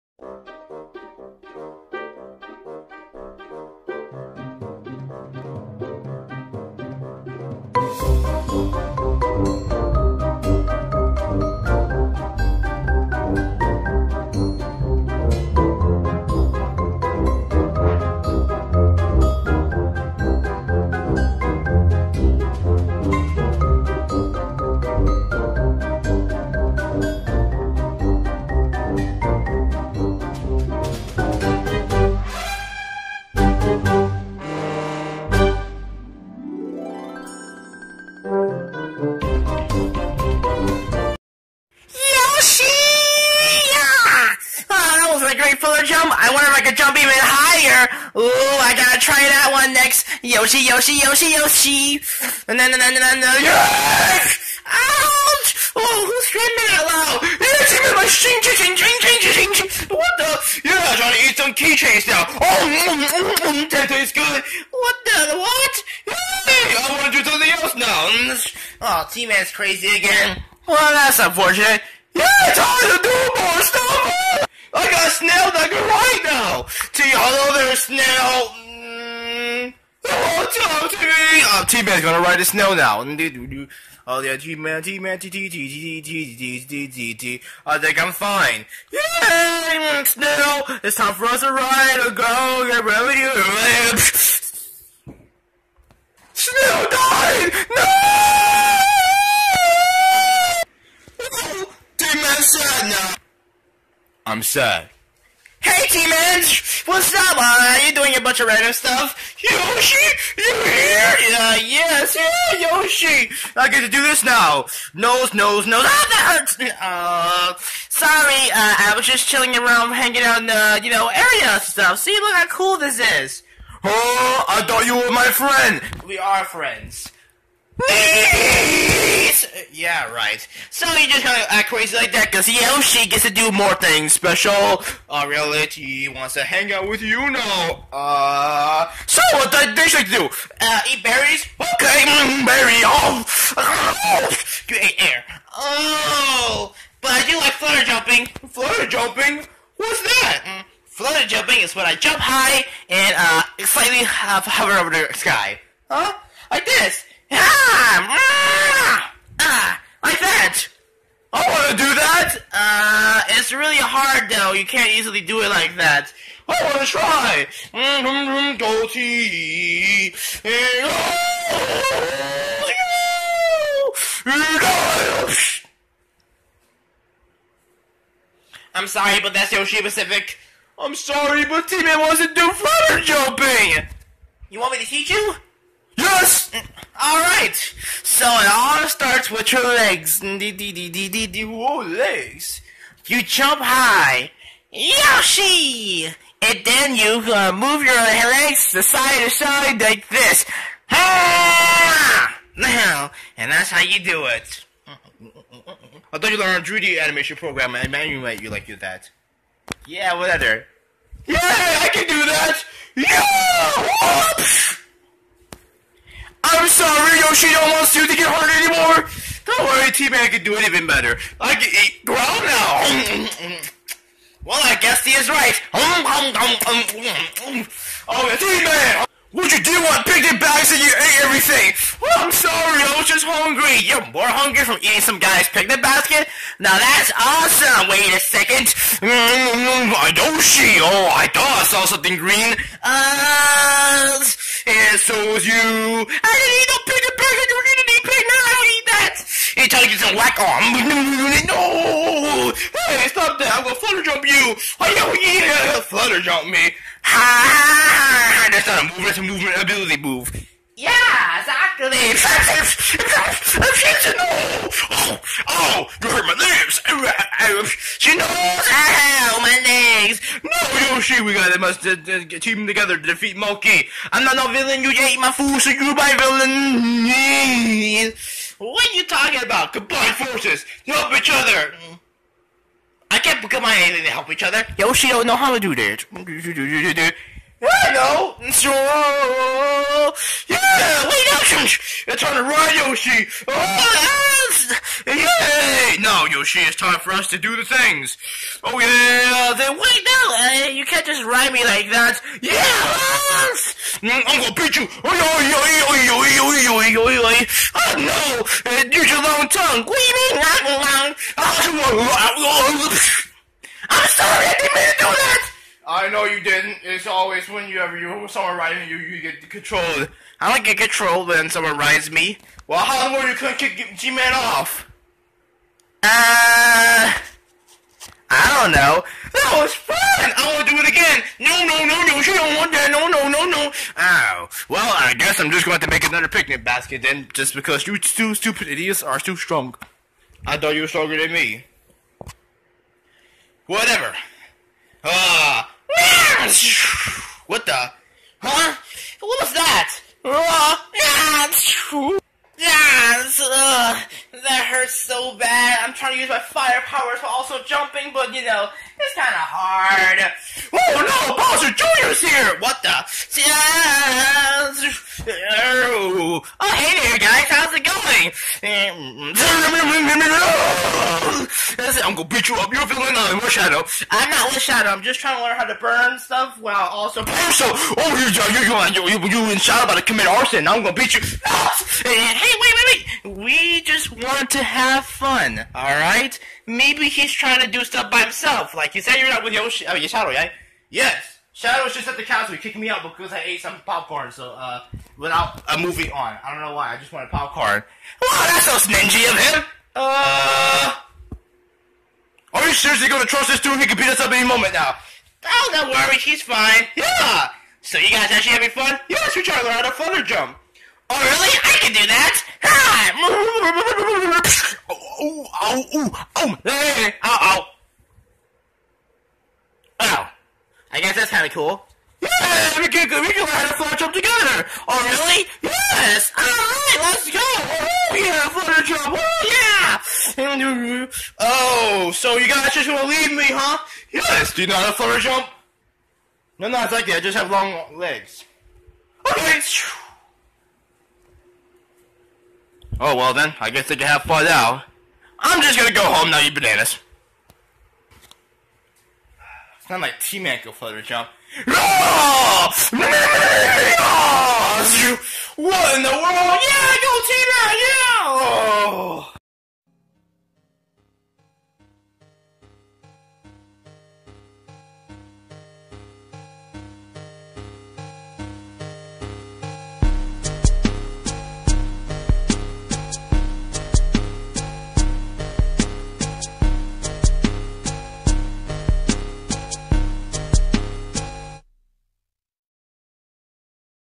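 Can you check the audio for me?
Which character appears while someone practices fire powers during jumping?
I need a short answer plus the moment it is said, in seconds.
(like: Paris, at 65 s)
Bowser Jr., at 361 s.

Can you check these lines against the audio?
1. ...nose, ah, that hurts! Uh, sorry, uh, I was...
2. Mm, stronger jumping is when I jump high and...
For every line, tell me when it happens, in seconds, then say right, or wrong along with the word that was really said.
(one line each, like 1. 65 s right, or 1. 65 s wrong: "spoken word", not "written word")
1. 115 s right
2. 150 s wrong: "flutter", not "stronger".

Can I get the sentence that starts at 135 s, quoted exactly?
Uh, reality wants to hang out with you now.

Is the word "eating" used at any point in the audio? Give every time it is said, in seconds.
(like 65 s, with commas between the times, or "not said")
234 s.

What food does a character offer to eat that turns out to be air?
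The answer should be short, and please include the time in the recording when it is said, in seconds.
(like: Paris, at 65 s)
Berries, at 140 s.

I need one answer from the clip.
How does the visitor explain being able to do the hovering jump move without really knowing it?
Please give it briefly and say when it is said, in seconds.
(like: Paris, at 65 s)
Long legs, at 437 s.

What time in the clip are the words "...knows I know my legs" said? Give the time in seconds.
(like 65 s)
268 s.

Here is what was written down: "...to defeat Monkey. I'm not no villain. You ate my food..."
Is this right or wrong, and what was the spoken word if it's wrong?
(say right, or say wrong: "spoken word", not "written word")
right.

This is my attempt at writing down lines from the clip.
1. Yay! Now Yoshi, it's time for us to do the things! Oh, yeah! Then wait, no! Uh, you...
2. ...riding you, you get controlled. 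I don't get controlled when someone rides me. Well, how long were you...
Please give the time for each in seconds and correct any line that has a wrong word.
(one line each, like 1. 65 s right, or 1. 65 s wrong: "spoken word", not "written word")
1. 295 s right
2. 318 s right.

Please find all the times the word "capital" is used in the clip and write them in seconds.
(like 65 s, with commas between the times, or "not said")
not said.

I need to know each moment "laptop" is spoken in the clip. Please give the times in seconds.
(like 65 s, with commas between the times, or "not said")
not said.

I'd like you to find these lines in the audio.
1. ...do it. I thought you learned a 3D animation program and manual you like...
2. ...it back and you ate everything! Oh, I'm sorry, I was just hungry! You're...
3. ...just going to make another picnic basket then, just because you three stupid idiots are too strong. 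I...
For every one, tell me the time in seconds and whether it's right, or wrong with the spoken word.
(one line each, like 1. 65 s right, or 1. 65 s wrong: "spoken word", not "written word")
1. 204 s right
2. 230 s right
3. 335 s wrong: "two", not "three".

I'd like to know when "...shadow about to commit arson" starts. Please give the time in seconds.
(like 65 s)
379 s.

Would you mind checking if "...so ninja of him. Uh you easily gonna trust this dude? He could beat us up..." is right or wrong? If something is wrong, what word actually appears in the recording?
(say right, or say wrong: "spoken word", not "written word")
wrong: "seriously", not "easily".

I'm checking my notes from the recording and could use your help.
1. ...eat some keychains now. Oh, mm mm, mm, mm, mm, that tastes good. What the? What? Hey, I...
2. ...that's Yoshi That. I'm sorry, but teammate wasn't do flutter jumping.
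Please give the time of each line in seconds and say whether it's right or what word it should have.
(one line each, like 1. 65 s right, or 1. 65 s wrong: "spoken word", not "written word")
1. 61 s right
2. 179 s wrong: "Pacific", not "That".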